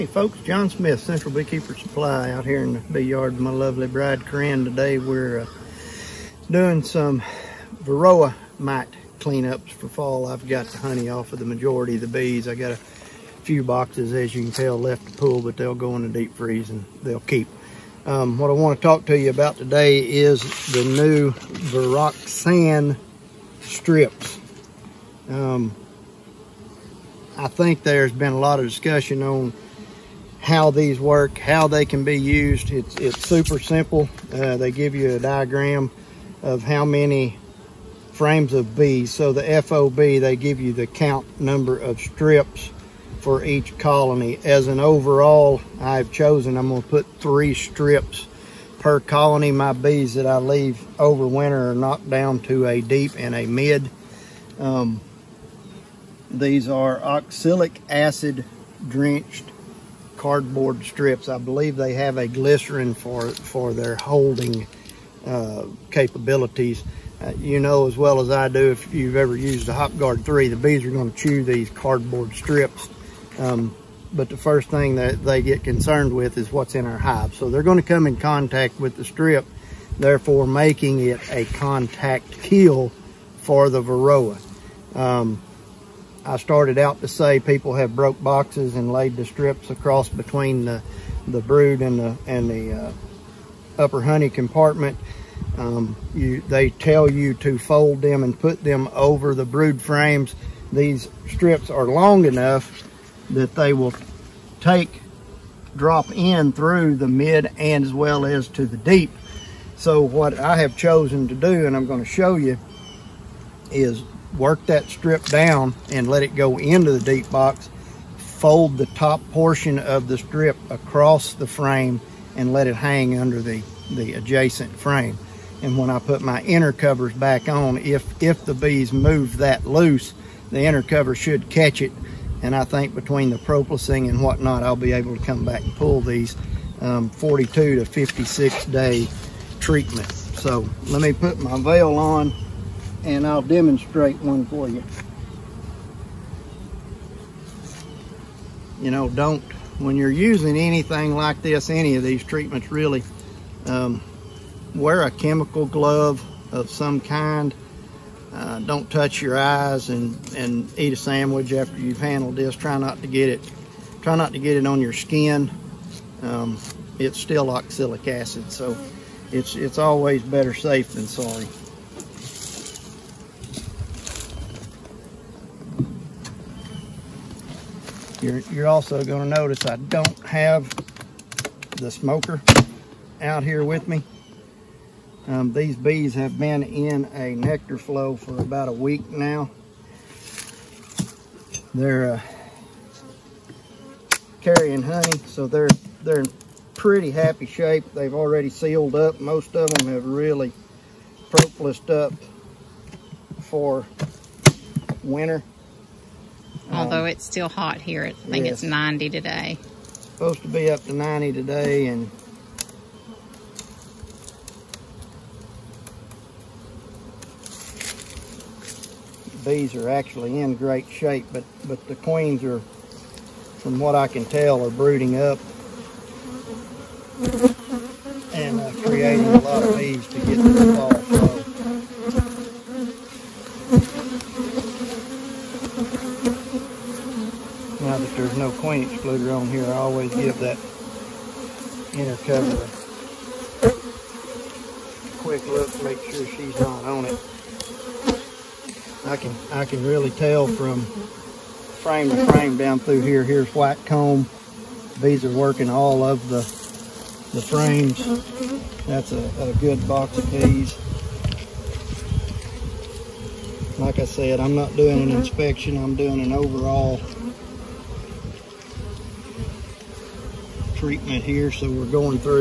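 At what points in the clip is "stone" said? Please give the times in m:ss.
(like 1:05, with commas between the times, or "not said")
not said.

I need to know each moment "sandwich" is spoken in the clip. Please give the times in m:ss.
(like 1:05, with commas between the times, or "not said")
2:40.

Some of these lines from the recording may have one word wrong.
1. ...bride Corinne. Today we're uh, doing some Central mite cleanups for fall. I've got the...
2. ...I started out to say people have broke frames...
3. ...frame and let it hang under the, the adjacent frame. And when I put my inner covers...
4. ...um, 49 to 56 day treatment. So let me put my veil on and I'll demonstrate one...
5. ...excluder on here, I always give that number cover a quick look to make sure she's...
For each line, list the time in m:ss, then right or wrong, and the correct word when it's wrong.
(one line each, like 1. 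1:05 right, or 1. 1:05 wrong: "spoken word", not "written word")
1. 0:03 wrong: "Varroa", not "Central"
2. 1:26 wrong: "boxes", not "frames"
3. 2:01 right
4. 2:16 wrong: "42", not "49"
5. 3:58 wrong: "inner", not "number".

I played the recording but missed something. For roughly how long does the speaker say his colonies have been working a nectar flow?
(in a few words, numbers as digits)
About a week.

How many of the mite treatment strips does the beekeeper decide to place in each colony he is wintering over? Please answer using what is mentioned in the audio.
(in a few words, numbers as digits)
3.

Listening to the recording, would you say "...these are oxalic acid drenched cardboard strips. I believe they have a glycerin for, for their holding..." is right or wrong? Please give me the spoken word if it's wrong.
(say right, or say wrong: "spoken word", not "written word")
right.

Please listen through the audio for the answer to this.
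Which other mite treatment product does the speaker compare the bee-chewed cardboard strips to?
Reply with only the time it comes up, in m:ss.
1:09.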